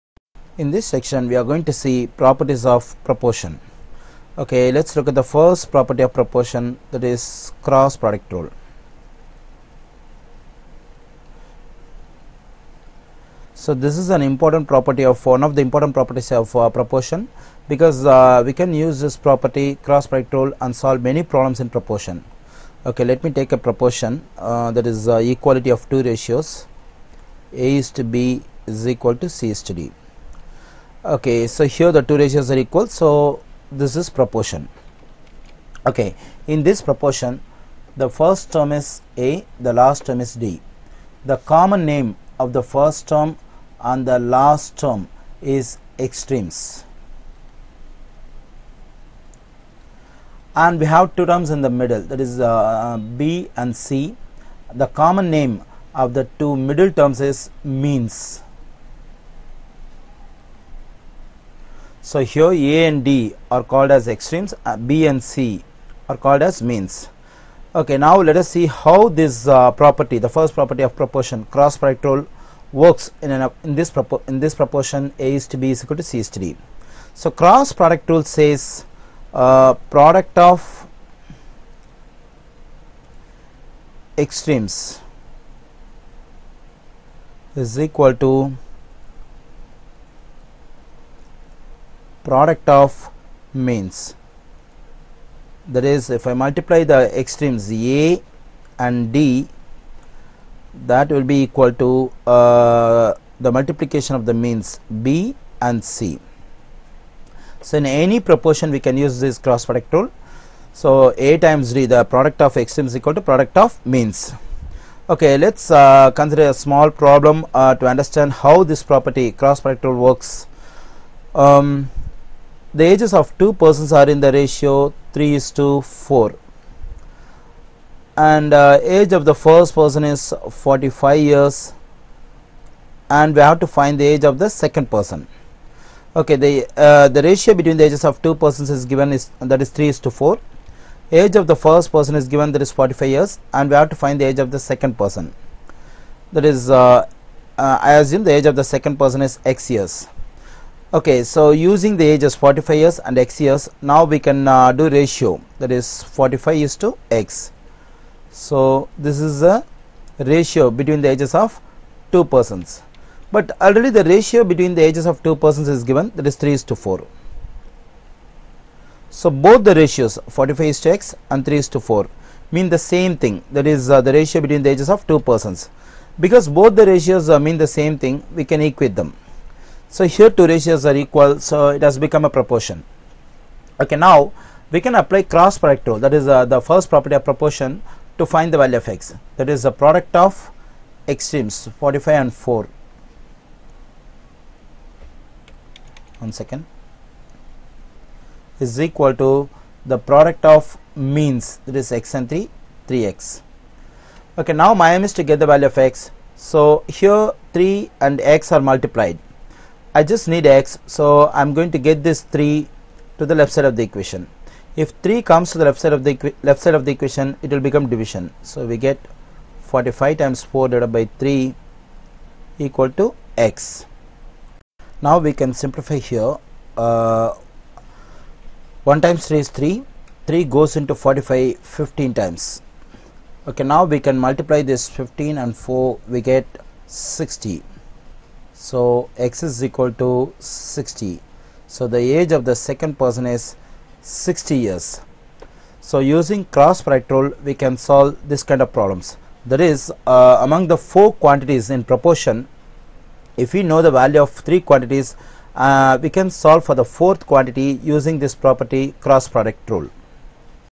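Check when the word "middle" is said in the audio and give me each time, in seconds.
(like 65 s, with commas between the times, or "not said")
51 s, 56 s.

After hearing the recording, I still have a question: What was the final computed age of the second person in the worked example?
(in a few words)
60 years.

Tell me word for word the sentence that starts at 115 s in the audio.
Okay, let us uh, consider a small problem uh, to understand how this property cross product rule works.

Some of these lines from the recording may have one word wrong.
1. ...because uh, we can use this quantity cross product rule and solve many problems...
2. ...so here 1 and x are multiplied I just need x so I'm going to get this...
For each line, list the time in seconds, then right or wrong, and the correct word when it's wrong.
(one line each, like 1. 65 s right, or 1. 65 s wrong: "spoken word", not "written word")
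1. 17 s wrong: "property", not "quantity"
2. 206 s wrong: "3", not "1".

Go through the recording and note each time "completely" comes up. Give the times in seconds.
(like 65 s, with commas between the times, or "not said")
not said.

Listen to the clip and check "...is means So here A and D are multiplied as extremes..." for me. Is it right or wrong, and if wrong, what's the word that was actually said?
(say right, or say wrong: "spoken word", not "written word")
wrong: "called", not "multiplied".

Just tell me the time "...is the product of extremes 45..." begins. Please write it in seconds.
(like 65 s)
189 s.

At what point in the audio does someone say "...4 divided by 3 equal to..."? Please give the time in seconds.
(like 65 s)
220 s.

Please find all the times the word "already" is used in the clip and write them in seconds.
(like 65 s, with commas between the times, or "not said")
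163 s.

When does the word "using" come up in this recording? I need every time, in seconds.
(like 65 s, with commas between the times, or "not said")
151 s, 246 s, 257 s.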